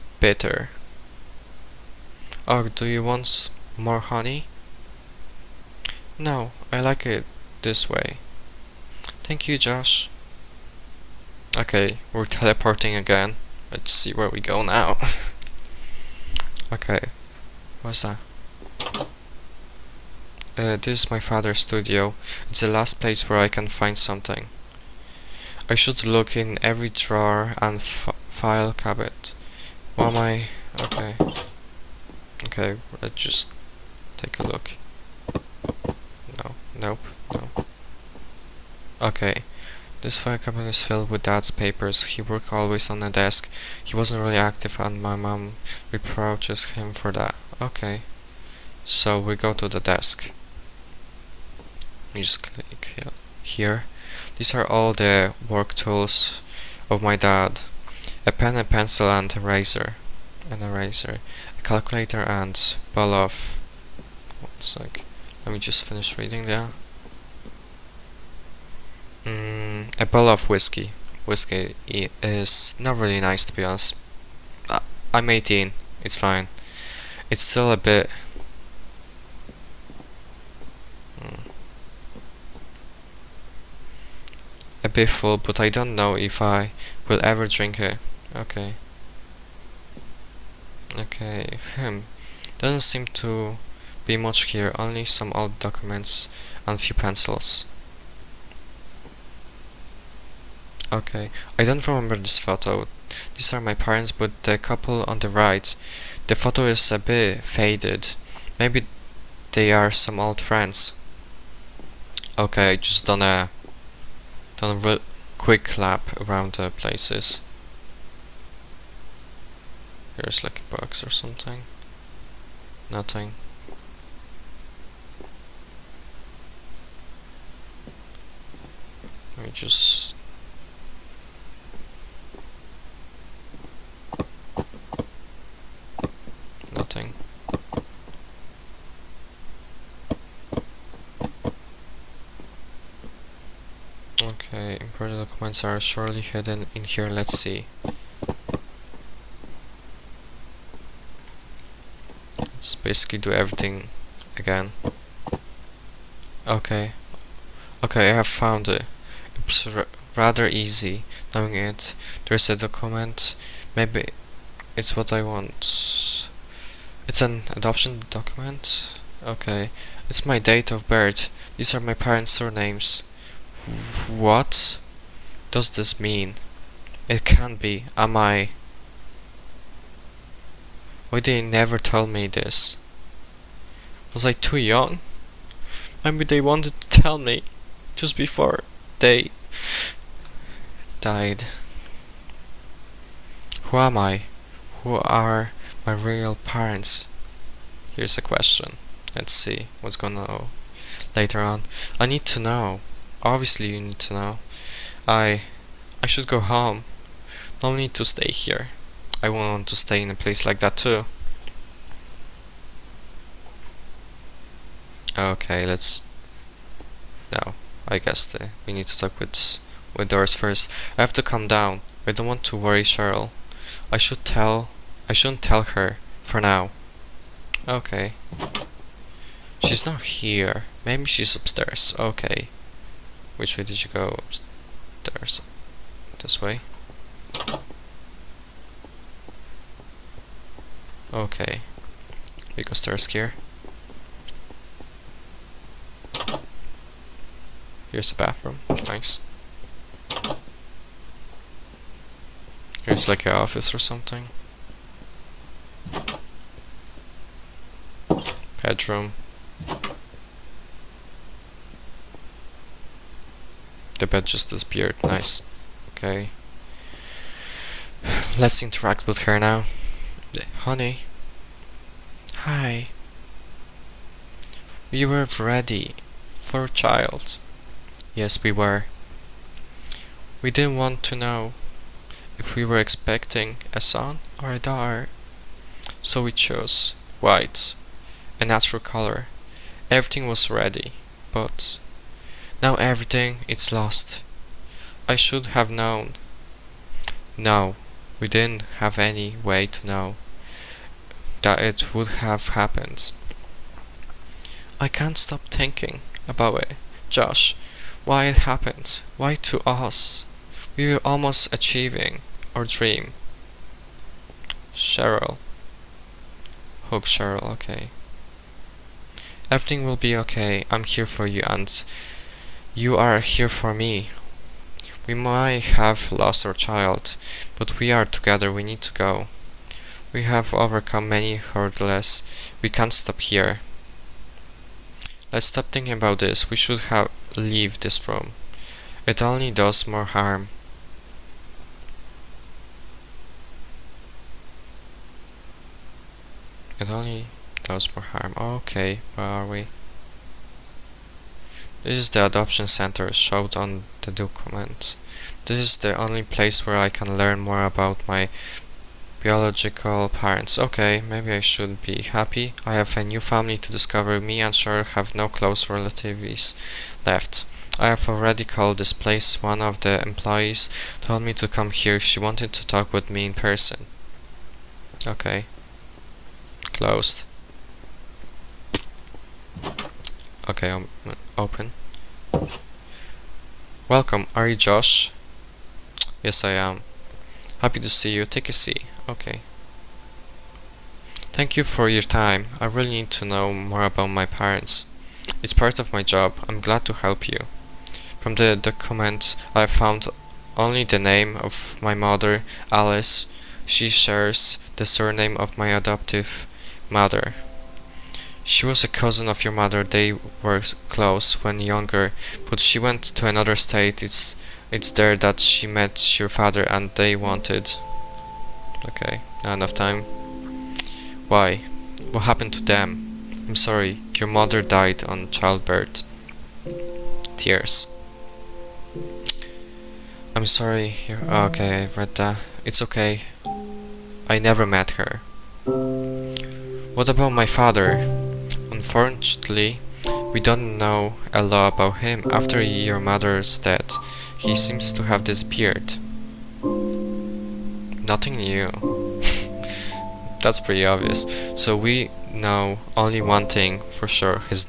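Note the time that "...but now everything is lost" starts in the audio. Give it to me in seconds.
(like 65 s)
291 s.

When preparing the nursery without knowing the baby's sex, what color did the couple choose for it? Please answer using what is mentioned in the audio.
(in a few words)
White.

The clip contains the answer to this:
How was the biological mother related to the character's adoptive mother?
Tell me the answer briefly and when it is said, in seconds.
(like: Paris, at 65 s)
Cousin, at 408 s.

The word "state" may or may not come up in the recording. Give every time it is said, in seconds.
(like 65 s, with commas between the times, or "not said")
413 s.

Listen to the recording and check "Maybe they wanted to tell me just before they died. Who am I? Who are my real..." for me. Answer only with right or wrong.
right.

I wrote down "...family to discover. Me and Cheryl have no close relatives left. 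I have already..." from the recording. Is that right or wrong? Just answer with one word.
right.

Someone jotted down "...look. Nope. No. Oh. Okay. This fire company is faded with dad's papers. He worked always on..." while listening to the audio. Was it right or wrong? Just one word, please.
wrong.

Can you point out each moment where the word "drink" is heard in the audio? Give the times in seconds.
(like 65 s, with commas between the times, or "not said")
87 s.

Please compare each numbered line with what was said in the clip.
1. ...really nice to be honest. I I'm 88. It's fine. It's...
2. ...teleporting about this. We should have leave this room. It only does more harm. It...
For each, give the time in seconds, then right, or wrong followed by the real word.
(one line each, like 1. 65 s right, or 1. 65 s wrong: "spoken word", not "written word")
1. 72 s wrong: "18", not "88"
2. 335 s wrong: "thinking", not "teleporting".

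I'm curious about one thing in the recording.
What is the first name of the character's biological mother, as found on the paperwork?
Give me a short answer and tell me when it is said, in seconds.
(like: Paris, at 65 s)
Alice, at 402 s.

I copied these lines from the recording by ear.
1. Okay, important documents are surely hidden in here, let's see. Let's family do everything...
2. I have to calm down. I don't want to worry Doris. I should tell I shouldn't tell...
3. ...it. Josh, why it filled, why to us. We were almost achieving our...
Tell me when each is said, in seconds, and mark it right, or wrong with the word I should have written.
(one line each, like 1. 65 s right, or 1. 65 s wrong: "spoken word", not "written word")
1. 144 s wrong: "basically", not "family"
2. 220 s wrong: "Cheryl", not "Doris"
3. 306 s wrong: "happened", not "filled".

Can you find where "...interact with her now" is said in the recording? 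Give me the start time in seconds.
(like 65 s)
268 s.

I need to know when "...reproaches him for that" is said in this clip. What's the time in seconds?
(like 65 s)
45 s.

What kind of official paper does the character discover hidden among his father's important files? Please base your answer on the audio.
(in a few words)
Adoption document.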